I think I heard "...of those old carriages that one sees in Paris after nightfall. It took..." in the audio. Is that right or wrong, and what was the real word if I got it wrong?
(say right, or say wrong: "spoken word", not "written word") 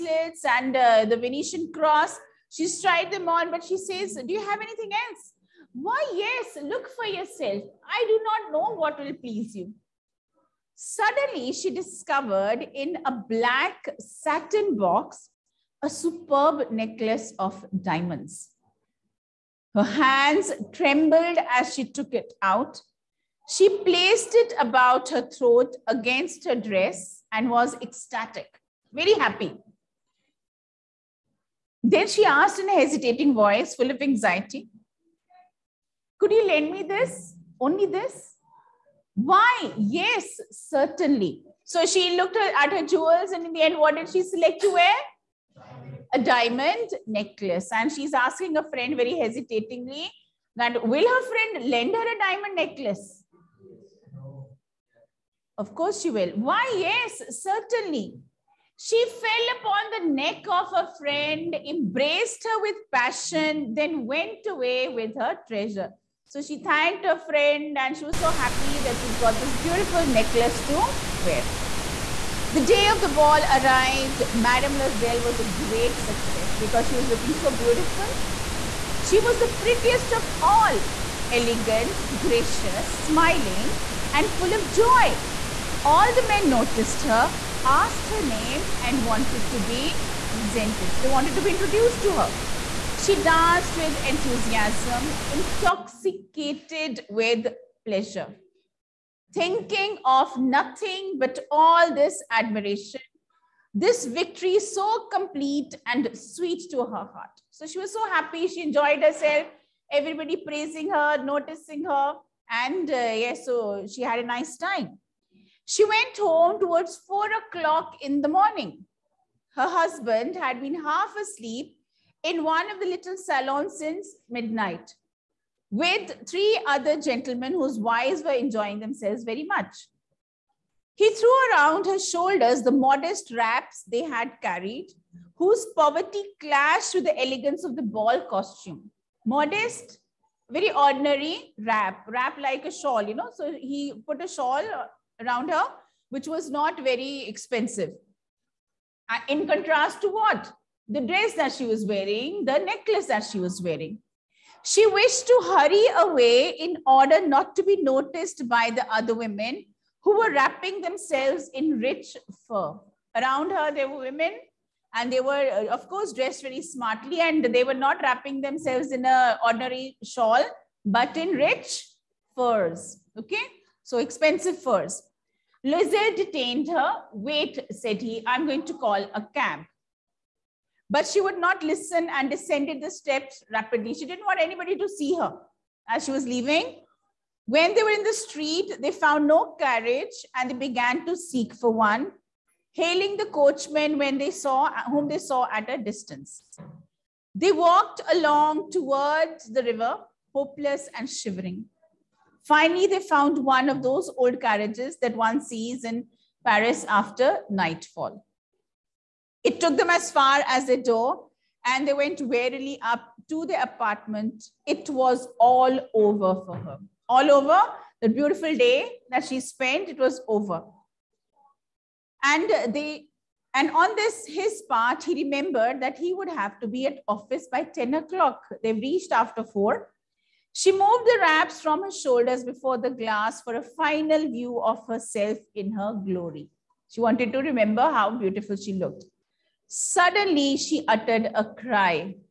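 right.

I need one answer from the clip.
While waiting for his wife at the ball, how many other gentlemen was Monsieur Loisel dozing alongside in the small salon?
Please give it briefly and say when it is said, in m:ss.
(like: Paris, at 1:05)
3, at 2:06.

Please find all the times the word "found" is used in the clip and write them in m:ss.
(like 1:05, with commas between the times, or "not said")
3:08, 3:22.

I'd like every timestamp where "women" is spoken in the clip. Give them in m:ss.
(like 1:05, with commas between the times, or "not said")
2:39, 2:43.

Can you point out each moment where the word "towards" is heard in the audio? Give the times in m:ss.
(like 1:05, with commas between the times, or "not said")
1:56, 3:18.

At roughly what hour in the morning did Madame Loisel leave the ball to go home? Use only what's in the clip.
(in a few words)
4 o'clock.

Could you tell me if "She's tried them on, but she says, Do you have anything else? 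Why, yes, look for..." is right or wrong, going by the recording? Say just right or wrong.
right.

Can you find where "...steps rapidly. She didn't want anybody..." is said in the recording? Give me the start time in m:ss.
3:02.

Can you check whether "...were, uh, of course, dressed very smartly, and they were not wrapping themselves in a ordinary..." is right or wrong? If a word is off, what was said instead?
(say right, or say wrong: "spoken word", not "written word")
right.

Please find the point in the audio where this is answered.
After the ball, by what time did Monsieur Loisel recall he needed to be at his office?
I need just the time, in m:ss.
3:47.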